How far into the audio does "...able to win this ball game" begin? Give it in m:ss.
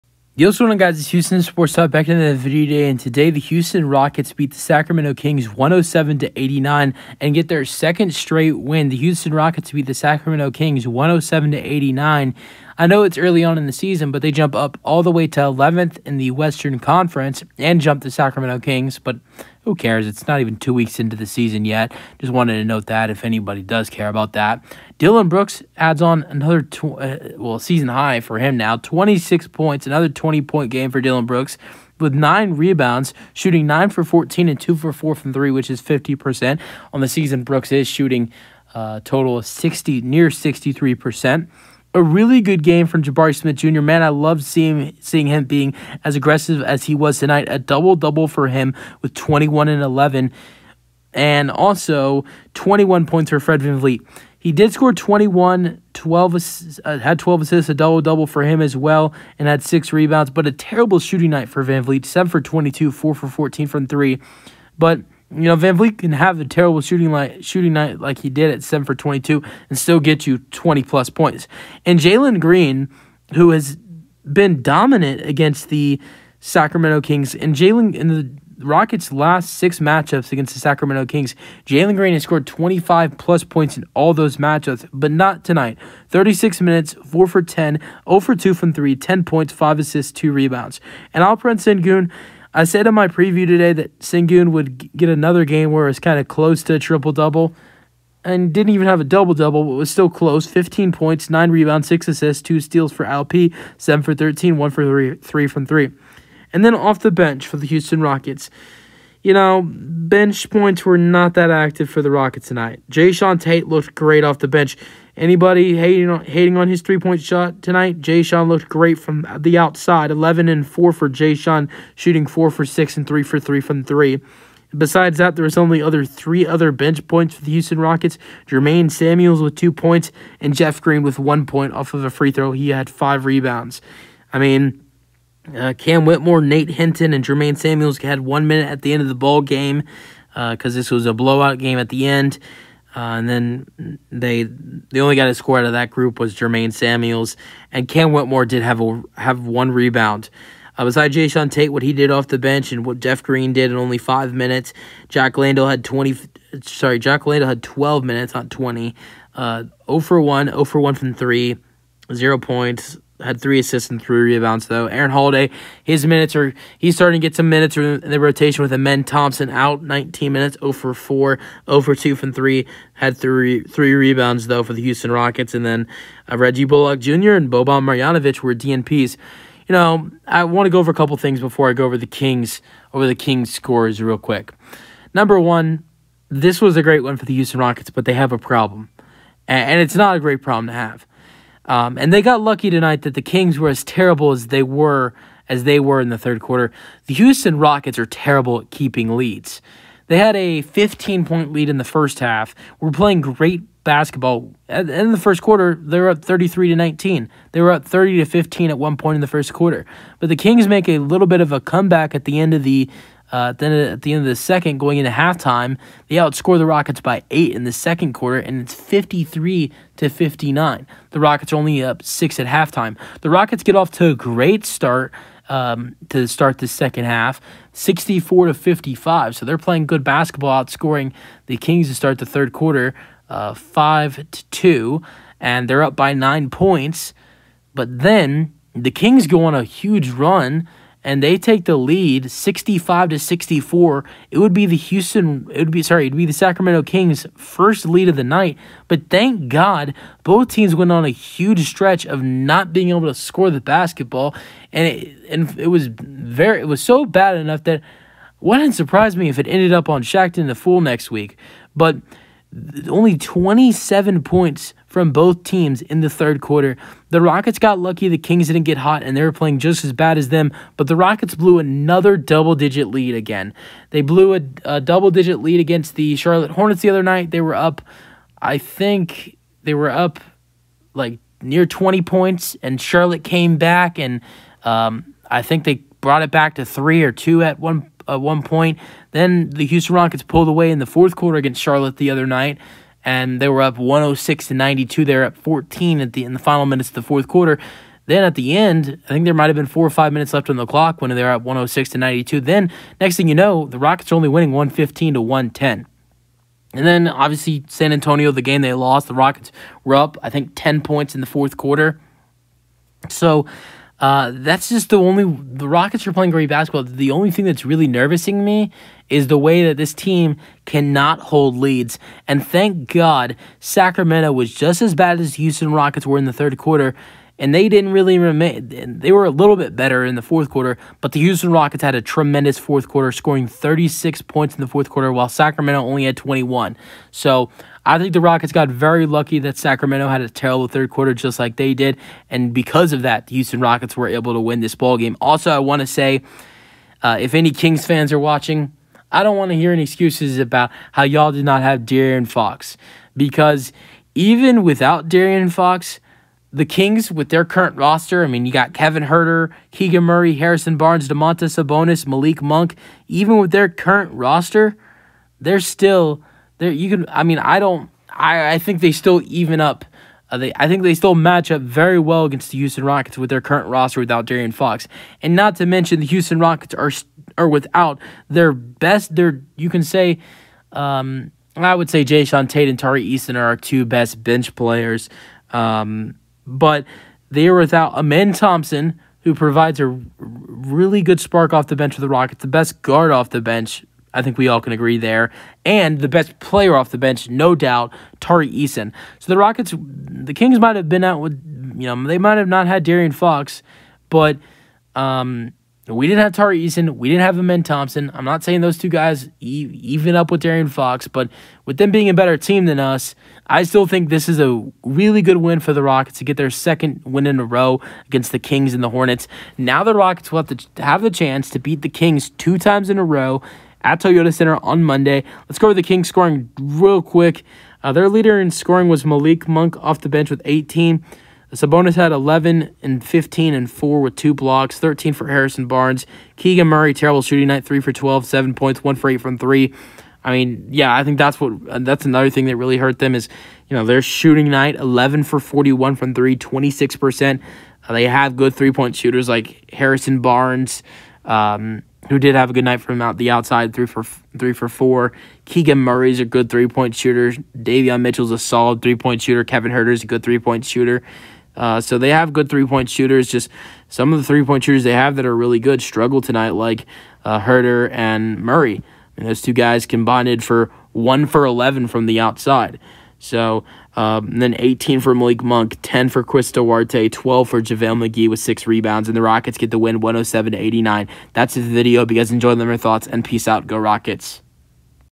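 5:44.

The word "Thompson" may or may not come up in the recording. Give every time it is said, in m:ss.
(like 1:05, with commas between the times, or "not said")
2:49, 6:28, 6:47.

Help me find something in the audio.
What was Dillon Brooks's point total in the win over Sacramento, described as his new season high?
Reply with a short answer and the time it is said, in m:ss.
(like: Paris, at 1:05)
26, at 0:28.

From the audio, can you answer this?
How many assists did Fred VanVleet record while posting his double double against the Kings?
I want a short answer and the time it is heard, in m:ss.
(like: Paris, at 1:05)
12, at 0:56.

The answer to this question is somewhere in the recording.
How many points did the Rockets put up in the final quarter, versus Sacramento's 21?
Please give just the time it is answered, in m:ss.
5:33.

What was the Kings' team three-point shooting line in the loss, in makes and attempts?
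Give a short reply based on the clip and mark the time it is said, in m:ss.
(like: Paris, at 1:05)
11 for 41, at 7:24.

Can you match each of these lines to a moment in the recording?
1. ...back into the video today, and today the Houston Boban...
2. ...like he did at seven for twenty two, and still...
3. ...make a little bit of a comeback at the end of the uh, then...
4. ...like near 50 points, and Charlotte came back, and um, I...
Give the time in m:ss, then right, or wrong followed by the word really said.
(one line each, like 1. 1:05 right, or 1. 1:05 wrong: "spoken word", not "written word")
1. 0:01 wrong: "Rockets", not "Boban"
2. 1:08 right
3. 3:30 right
4. 4:40 wrong: "20", not "50".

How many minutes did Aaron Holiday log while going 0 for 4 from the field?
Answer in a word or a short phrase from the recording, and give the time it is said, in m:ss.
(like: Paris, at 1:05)
19, at 2:49.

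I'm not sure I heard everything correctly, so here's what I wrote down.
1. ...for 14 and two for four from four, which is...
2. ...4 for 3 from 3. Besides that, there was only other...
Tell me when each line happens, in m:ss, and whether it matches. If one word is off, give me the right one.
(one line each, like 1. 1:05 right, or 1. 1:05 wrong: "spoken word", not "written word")
1. 0:33 wrong: "three", not "four"
2. 2:03 wrong: "3", not "4".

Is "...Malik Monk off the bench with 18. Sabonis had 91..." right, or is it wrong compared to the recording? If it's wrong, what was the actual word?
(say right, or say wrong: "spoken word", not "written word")
wrong: "11", not "91".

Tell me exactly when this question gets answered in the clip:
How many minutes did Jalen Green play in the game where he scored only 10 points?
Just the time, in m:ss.
1:26.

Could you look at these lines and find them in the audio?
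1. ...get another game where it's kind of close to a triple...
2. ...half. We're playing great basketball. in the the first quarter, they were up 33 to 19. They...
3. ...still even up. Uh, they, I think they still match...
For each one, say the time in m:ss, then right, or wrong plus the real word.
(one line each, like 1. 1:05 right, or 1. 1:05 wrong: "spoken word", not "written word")
1. 1:34 right
2. 3:22 right
3. 6:08 right.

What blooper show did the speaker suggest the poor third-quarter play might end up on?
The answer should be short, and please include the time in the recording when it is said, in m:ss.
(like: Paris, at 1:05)
Shaqtin' the Fool, at 4:20.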